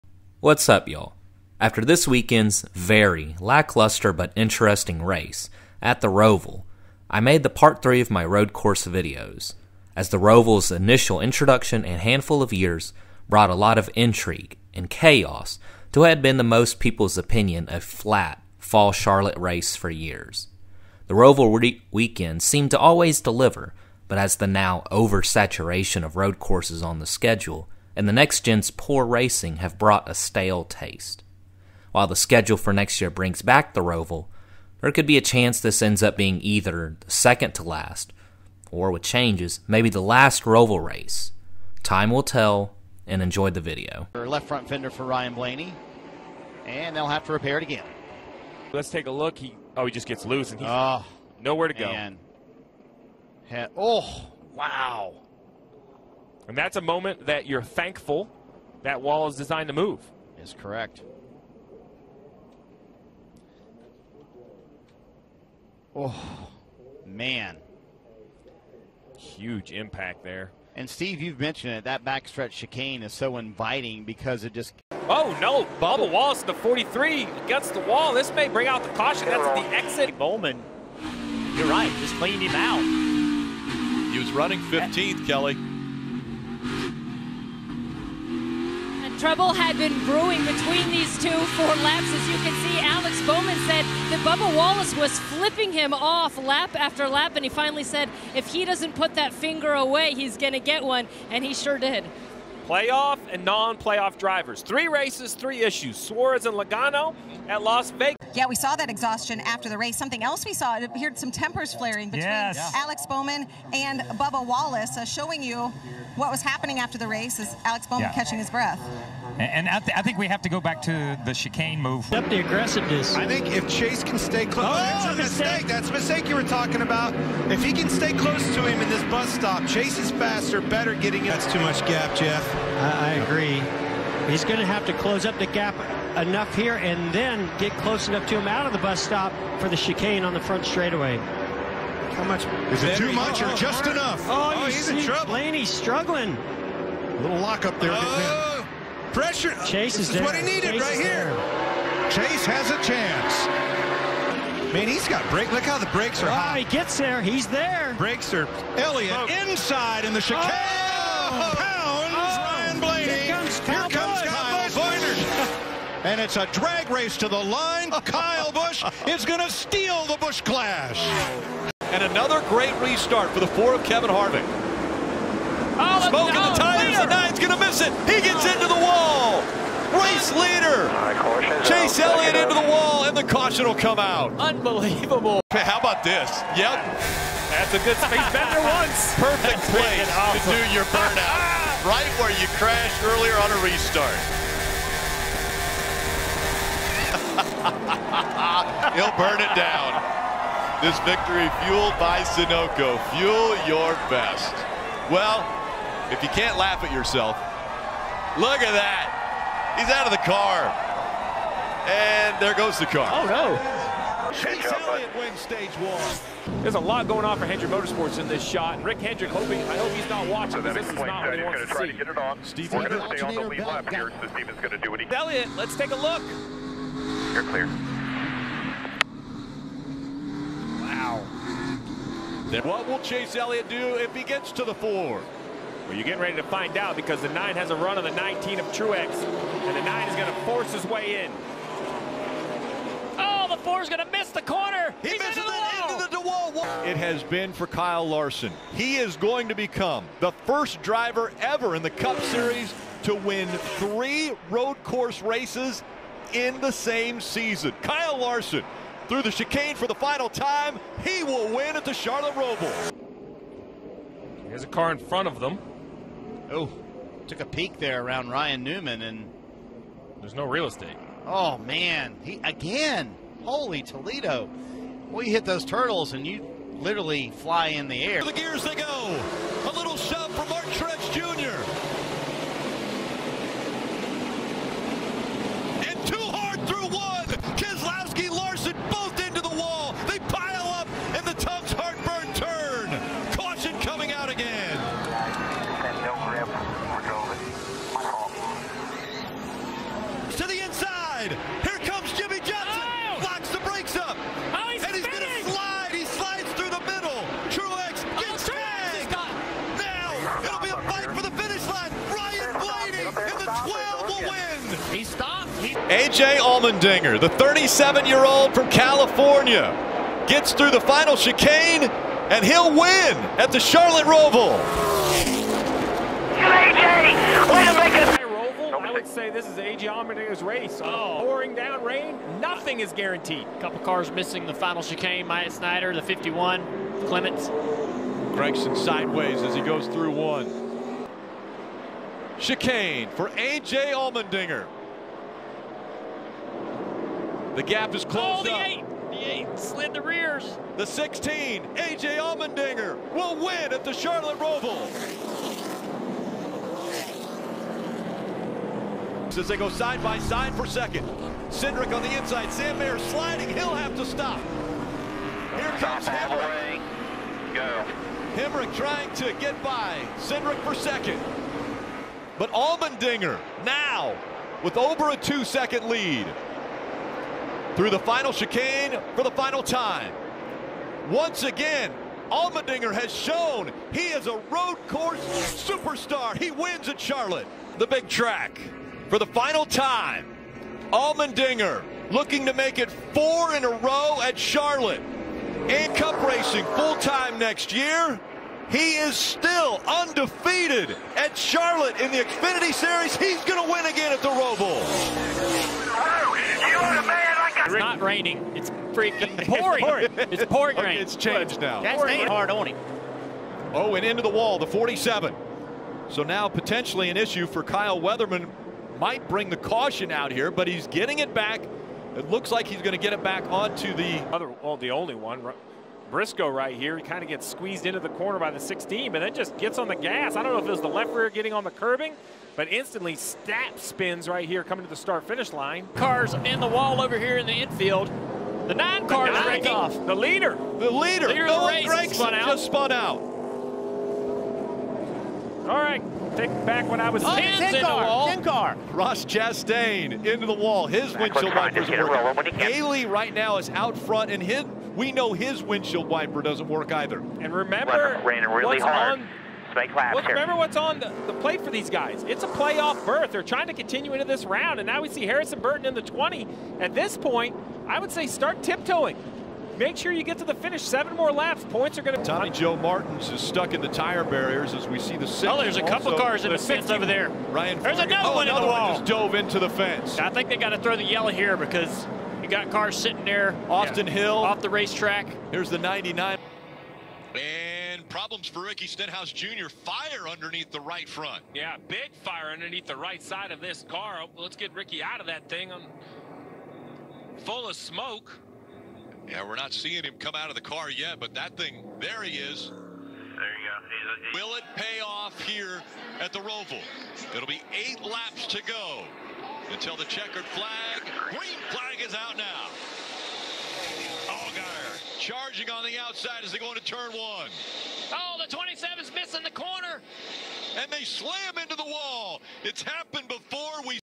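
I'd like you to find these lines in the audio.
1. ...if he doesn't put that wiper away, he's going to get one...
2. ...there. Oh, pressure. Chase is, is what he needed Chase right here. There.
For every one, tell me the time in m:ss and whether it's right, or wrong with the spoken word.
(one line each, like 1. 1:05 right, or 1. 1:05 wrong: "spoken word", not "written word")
1. 1:38 wrong: "finger", not "wiper"
2. 2:27 right.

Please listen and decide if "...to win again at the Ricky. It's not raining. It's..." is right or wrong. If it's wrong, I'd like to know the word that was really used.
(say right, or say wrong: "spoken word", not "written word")
wrong: "Roval", not "Ricky".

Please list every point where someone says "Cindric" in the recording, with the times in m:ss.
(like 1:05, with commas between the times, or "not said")
6:01, 6:10.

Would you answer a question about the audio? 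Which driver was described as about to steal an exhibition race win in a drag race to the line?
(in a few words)
Kyle Busch.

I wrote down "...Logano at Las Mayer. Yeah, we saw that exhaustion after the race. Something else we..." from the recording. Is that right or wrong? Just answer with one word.
wrong.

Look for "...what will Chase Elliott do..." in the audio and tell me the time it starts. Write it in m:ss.
3:52.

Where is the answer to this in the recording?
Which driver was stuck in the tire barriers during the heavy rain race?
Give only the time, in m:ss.
7:52.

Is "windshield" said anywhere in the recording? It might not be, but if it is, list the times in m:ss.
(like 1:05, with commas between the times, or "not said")
7:31, 7:35.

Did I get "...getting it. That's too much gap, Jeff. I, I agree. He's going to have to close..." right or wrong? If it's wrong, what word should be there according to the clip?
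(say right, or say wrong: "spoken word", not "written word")
right.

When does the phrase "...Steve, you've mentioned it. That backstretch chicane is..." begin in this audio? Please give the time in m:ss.
1:10.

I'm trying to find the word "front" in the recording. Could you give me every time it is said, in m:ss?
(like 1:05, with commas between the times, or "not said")
0:44, 2:20, 4:24, 7:33, 8:11.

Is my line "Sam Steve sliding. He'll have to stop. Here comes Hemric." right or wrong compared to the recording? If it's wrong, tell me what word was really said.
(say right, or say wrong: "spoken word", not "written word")
wrong: "Mayer", not "Steve".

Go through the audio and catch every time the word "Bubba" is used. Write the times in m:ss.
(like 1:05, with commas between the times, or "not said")
1:15, 1:34, 1:54.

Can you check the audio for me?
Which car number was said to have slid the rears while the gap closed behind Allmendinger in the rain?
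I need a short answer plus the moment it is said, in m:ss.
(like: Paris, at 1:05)
8, at 5:49.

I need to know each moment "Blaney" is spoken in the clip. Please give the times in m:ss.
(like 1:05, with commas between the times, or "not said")
0:45, 2:25.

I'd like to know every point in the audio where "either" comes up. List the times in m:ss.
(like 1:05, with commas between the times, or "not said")
0:36, 7:36.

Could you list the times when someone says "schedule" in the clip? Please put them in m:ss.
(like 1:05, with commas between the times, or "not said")
0:27, 0:32.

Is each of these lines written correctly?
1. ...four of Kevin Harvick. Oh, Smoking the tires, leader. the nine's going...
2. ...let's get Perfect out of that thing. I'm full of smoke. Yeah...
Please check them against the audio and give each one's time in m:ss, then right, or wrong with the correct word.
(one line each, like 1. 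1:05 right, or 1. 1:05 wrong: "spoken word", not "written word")
1. 2:53 right
2. 8:14 wrong: "Ricky", not "Perfect".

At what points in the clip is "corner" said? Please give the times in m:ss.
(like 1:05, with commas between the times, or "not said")
4:04, 7:08, 8:39.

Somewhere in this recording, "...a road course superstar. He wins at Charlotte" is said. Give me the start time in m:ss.
6:24.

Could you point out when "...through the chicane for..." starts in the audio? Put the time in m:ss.
4:19.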